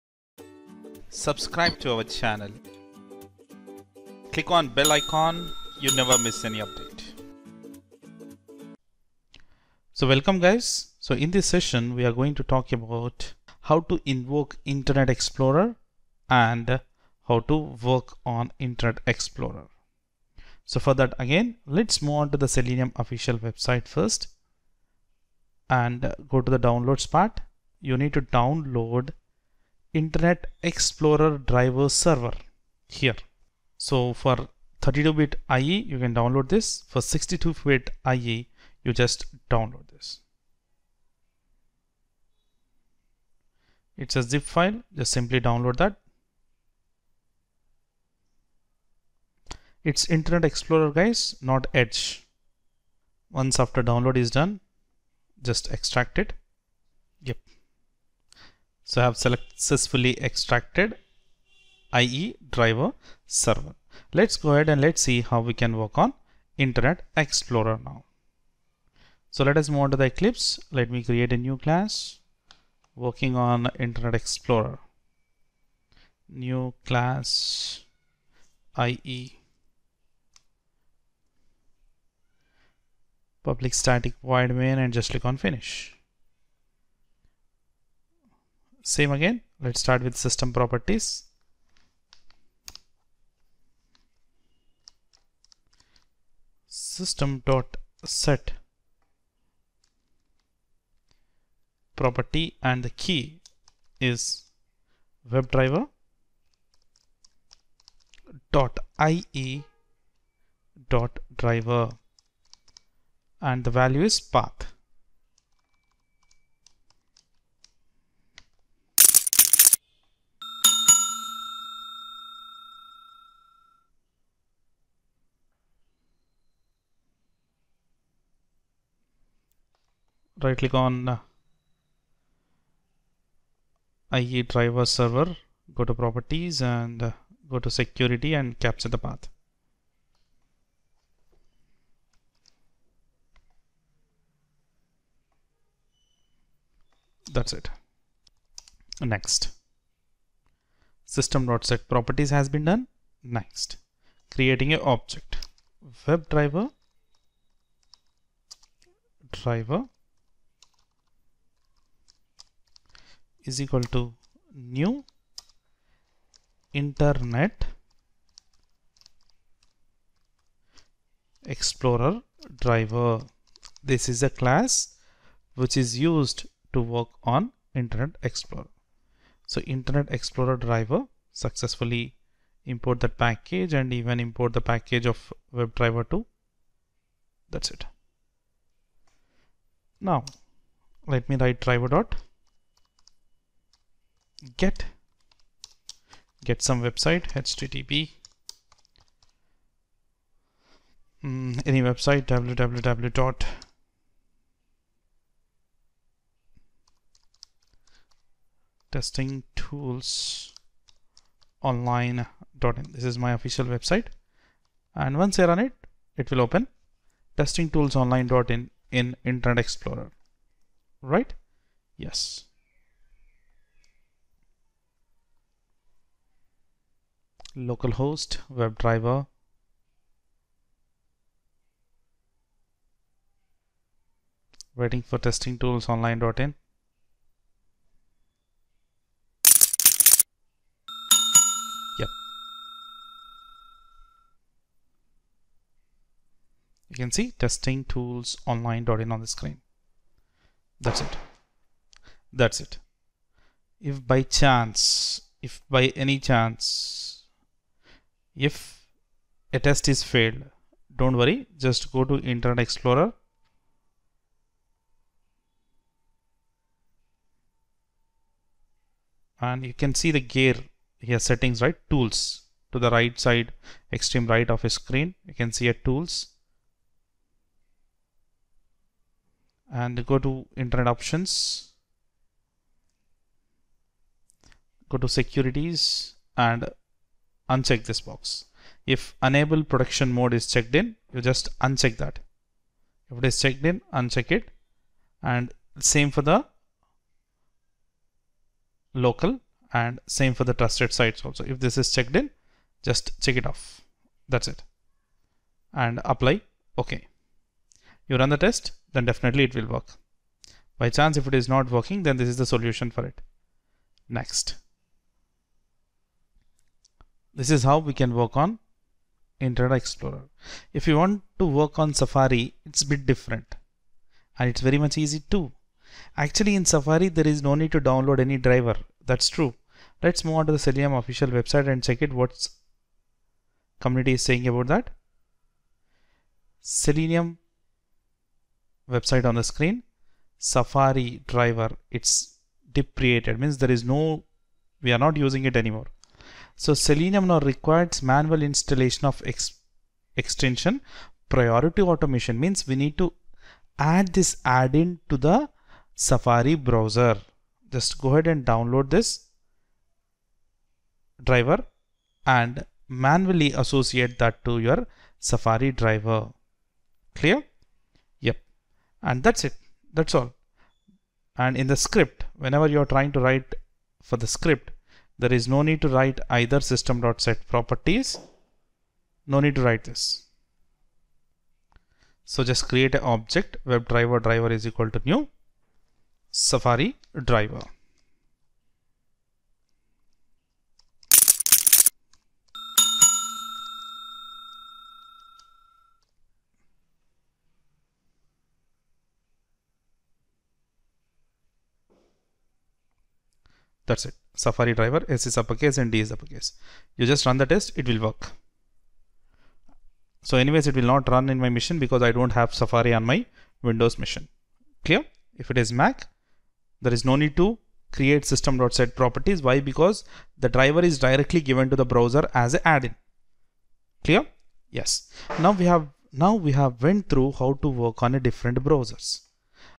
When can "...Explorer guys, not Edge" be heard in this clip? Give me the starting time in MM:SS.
00:50.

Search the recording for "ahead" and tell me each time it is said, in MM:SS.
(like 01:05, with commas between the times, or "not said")
01:04, 05:58.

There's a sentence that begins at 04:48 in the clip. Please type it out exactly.
If enable production mode is checked in, you just uncheck that.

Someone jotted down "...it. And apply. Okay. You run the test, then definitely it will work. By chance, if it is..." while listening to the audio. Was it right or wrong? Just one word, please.
right.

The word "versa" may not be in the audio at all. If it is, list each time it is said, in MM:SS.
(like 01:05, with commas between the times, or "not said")
not said.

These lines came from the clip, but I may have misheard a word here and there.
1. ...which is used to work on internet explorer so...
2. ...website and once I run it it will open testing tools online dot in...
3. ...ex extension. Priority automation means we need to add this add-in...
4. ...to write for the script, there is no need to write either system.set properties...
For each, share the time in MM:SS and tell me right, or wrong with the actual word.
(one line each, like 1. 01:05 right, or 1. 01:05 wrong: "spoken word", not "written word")
1. 02:55 right
2. 03:33 right
3. 05:49 right
4. 06:13 right.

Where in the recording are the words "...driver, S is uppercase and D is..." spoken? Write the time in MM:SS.
06:44.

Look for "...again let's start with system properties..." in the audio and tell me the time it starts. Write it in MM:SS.
01:29.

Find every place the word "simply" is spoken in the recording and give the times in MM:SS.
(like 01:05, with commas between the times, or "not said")
00:45.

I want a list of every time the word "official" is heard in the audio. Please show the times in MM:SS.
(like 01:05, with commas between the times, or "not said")
00:22, 03:33, 05:30.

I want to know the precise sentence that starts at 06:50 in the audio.
So anyways, it will not run in my machine because I don't have Safari on my Windows machine.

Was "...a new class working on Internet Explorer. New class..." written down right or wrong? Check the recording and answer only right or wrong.
right.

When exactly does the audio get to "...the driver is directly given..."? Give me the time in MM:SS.
07:00.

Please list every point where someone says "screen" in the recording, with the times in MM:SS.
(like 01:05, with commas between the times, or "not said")
04:09, 04:34, 05:39.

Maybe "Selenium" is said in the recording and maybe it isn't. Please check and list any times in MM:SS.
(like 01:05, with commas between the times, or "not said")
00:22, 05:30, 05:36, 05:46.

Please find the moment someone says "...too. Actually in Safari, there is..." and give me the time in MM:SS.
05:25.